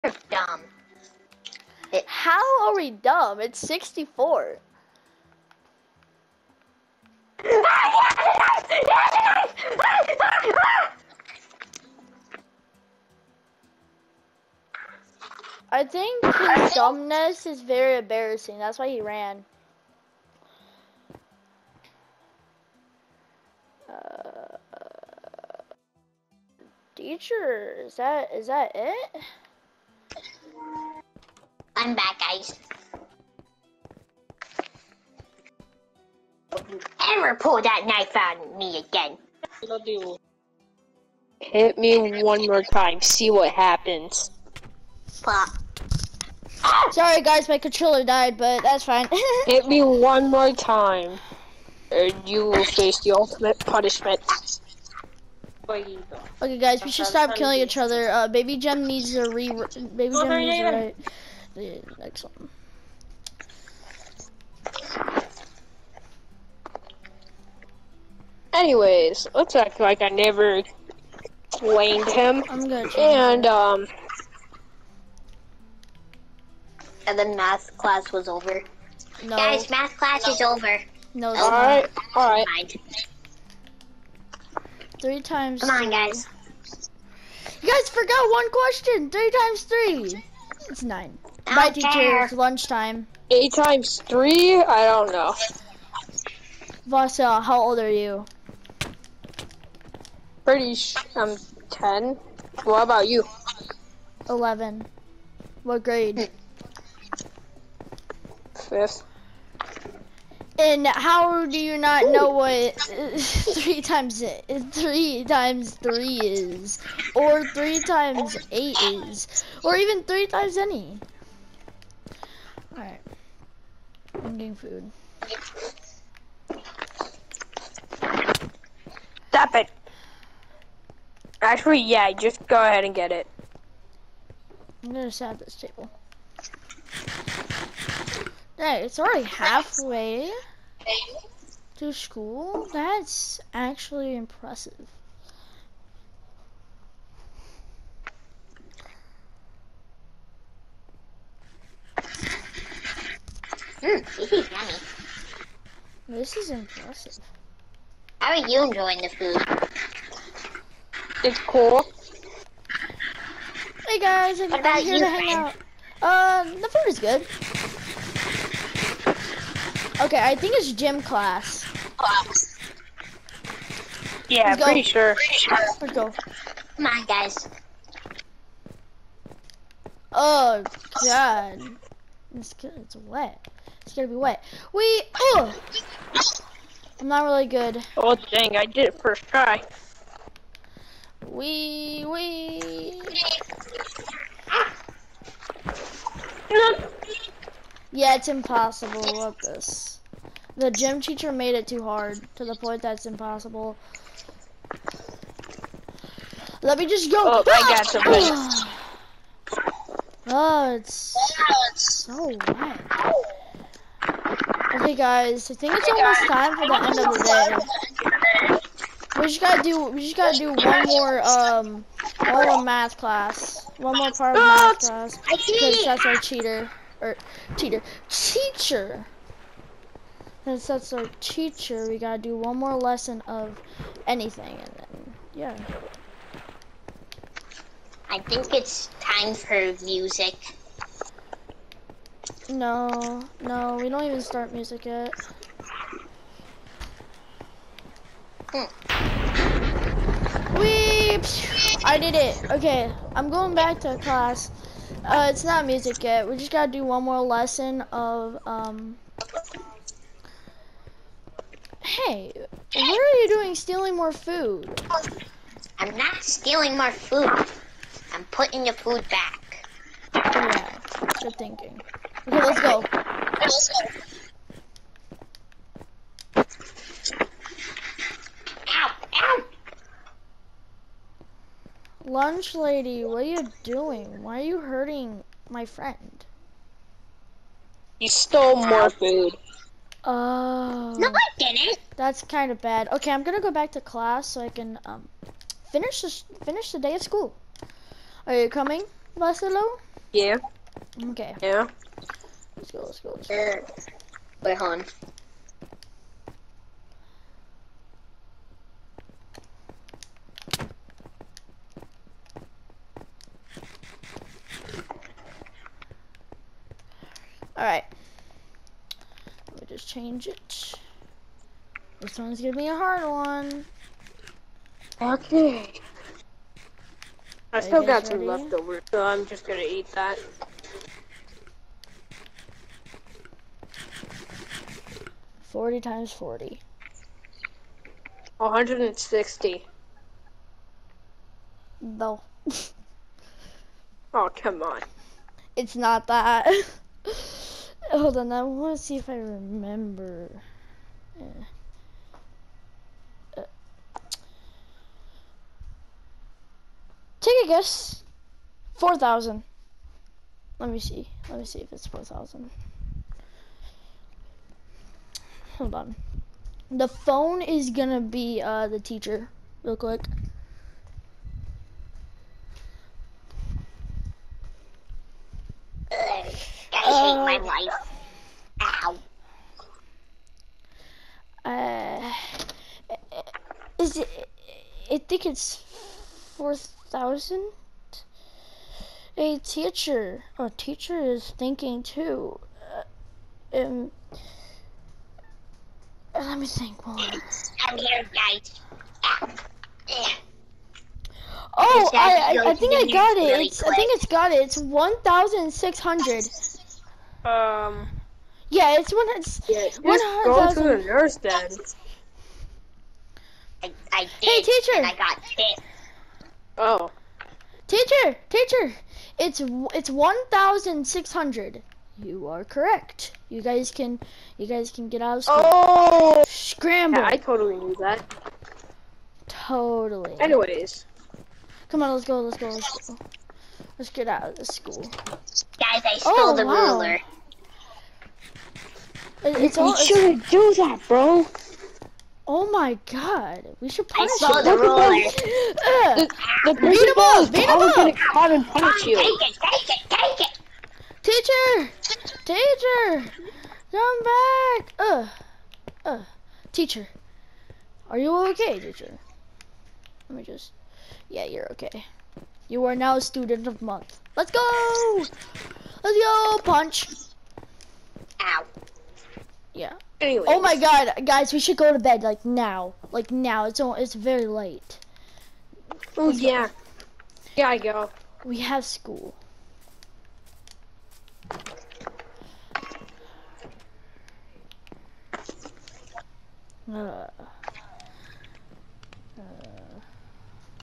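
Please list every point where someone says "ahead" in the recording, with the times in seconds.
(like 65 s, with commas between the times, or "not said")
132 s.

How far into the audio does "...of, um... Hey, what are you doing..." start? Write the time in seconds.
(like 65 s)
257 s.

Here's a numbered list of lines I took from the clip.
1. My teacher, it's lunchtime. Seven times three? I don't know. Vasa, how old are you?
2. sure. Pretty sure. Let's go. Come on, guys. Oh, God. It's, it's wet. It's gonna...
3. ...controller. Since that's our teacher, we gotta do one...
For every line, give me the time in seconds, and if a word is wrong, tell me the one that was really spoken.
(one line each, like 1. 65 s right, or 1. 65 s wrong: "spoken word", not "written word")
1. 91 s wrong: "Eight", not "Seven"
2. 174 s right
3. 228 s wrong: "teacher", not "controller".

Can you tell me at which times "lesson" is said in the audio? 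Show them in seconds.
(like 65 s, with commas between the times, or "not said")
232 s, 257 s.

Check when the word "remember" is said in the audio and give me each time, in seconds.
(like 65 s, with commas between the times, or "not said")
349 s.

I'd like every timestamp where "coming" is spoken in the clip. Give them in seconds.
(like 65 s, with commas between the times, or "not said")
298 s.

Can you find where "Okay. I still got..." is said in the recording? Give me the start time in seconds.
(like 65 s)
325 s.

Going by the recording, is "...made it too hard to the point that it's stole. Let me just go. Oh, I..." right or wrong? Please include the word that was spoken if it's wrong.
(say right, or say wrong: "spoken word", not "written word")
wrong: "impossible", not "stole".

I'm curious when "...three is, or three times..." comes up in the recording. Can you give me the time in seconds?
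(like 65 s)
115 s.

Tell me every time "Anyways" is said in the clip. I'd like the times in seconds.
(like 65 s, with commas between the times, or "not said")
68 s, 430 s, 470 s.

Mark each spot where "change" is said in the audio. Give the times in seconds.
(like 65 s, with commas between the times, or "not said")
319 s.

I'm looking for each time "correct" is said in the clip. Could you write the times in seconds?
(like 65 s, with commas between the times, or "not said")
422 s.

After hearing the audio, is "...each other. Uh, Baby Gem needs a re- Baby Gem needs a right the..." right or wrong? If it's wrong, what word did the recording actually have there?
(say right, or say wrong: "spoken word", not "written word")
right.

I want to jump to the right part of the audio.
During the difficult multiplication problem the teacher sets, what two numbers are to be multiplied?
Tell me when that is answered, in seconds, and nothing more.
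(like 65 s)
335 s.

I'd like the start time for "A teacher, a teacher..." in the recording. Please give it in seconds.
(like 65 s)
389 s.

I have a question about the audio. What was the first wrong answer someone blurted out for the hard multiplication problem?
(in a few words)
160.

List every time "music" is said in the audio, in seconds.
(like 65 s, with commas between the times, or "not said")
239 s, 244 s, 255 s.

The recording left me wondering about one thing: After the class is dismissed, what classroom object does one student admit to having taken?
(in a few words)
The ruler.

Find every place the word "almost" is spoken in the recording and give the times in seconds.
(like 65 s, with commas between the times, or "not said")
215 s.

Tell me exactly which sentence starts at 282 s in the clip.
Lunch lady, what are you doing?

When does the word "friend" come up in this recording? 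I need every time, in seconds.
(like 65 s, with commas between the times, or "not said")
165 s, 285 s.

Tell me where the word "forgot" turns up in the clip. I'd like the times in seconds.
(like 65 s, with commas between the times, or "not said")
87 s.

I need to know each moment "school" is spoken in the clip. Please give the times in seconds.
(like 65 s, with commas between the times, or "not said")
141 s, 297 s, 425 s, 434 s, 478 s.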